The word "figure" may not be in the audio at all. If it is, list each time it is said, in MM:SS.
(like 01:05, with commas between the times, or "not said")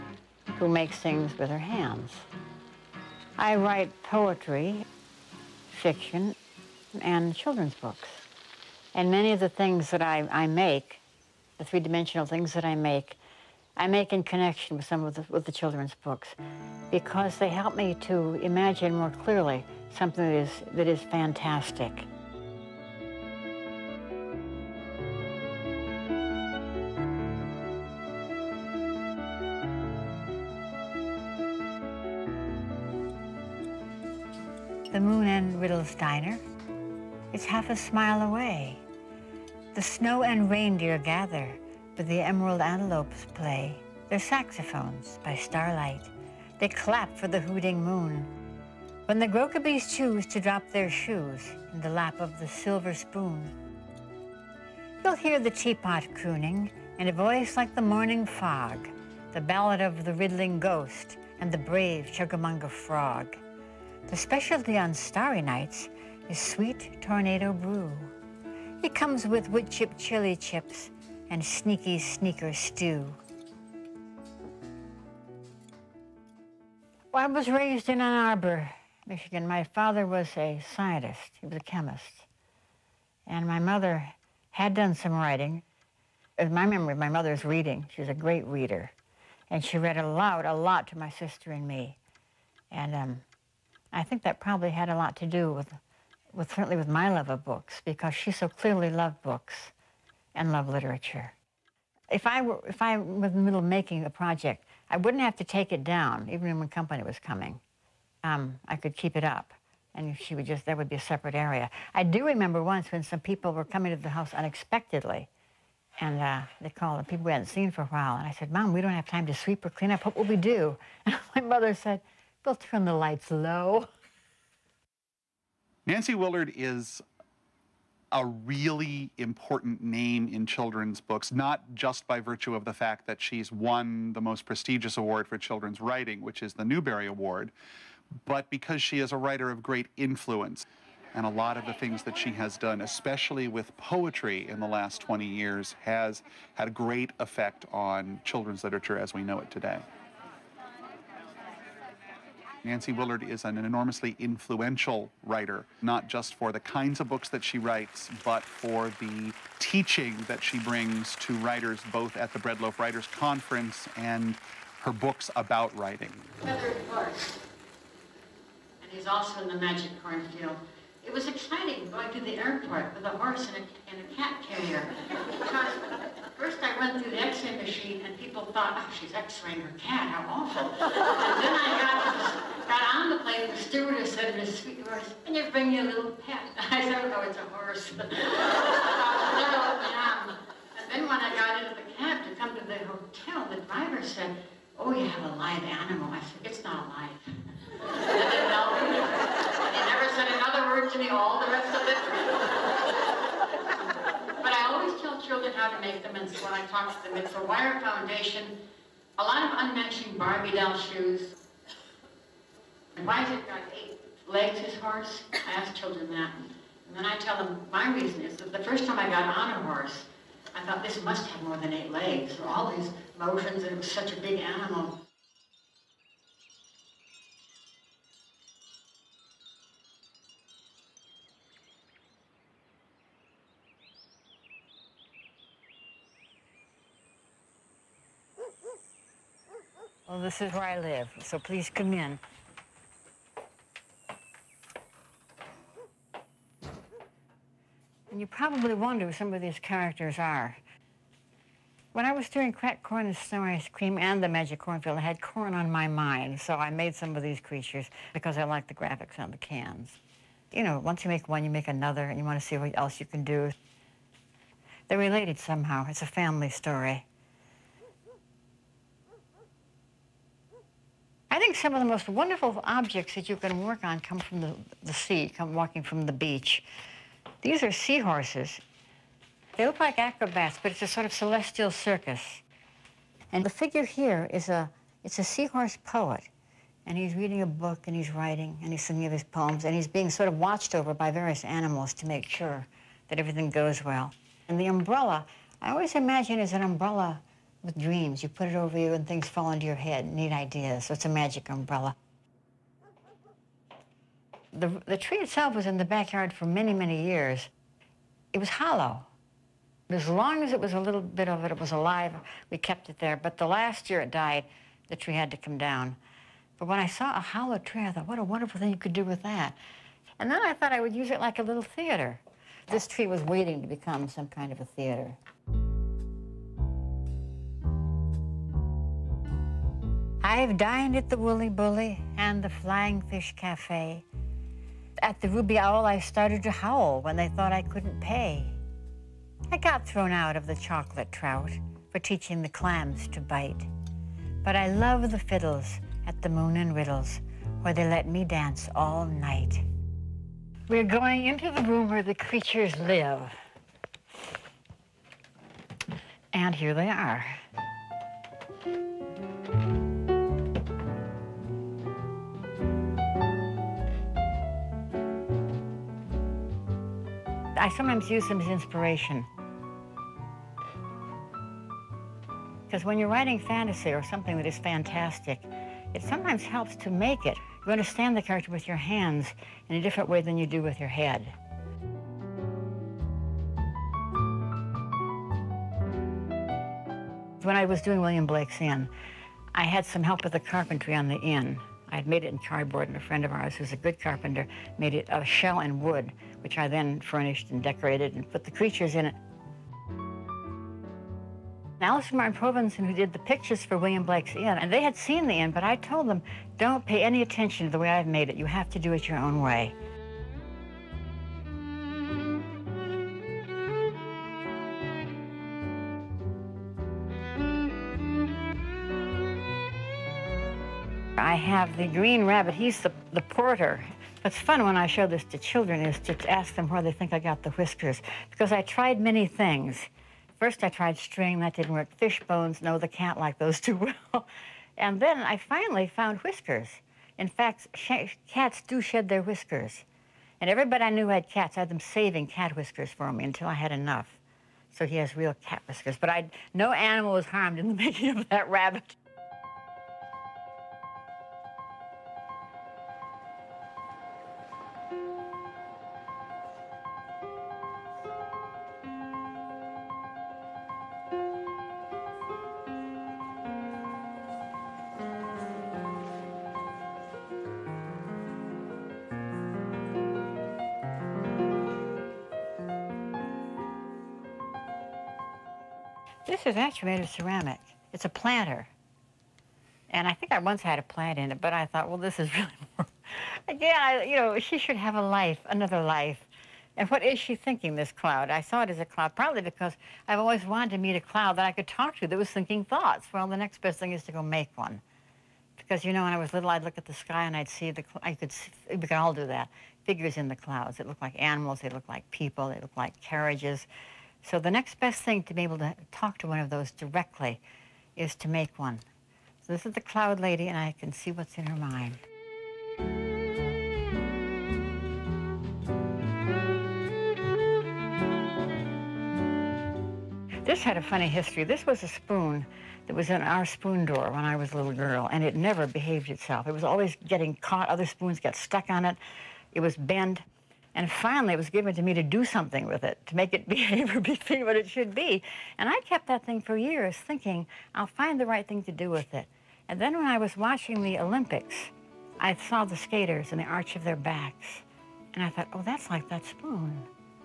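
04:43, 08:19.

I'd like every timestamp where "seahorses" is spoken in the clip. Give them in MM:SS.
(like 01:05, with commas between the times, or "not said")
04:37, 04:45.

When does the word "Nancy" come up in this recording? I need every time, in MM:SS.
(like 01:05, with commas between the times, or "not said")
02:05, 02:32.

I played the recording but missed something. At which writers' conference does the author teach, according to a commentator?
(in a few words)
Breadloaf Writers Conference.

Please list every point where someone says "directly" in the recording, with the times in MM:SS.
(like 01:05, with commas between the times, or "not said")
08:26.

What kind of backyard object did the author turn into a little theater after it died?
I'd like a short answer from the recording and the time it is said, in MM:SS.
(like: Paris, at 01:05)
A hollow tree, at 05:17.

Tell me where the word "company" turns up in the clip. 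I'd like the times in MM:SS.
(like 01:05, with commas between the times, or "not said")
01:46.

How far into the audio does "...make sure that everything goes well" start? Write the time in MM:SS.
04:52.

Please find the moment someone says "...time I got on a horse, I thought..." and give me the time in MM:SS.
03:38.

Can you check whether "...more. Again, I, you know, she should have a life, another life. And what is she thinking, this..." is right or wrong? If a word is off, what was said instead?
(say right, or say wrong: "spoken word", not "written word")
right.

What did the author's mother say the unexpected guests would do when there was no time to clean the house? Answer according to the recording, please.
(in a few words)
Turn the lights low.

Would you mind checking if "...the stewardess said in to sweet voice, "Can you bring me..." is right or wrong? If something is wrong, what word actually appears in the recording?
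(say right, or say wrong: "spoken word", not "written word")
right.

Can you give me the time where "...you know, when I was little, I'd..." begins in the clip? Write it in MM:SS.
08:15.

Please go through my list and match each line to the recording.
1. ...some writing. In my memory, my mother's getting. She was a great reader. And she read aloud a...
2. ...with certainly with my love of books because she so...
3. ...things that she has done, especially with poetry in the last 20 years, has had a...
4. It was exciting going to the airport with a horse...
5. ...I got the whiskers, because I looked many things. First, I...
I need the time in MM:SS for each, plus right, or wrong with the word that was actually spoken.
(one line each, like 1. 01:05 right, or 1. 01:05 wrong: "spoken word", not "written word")
1. 01:24 wrong: "reading", not "getting"
2. 01:36 right
3. 02:21 right
4. 02:51 right
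5. 07:07 wrong: "tried", not "looked".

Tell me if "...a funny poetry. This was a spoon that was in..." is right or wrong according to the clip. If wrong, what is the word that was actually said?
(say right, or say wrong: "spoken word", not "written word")
wrong: "history", not "poetry".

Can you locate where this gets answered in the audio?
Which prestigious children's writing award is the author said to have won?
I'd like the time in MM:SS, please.
02:16.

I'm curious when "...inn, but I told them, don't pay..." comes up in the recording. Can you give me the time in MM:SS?
06:45.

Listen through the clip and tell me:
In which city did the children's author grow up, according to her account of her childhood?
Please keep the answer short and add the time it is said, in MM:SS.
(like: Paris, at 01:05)
Ann Arbor, Michigan, at 01:18.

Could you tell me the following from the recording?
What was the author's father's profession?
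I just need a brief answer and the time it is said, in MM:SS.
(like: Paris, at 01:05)
Chemist, at 01:21.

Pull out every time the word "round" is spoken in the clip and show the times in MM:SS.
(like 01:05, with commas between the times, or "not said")
not said.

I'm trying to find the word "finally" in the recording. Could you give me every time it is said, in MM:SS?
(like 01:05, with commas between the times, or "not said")
07:15, 08:50.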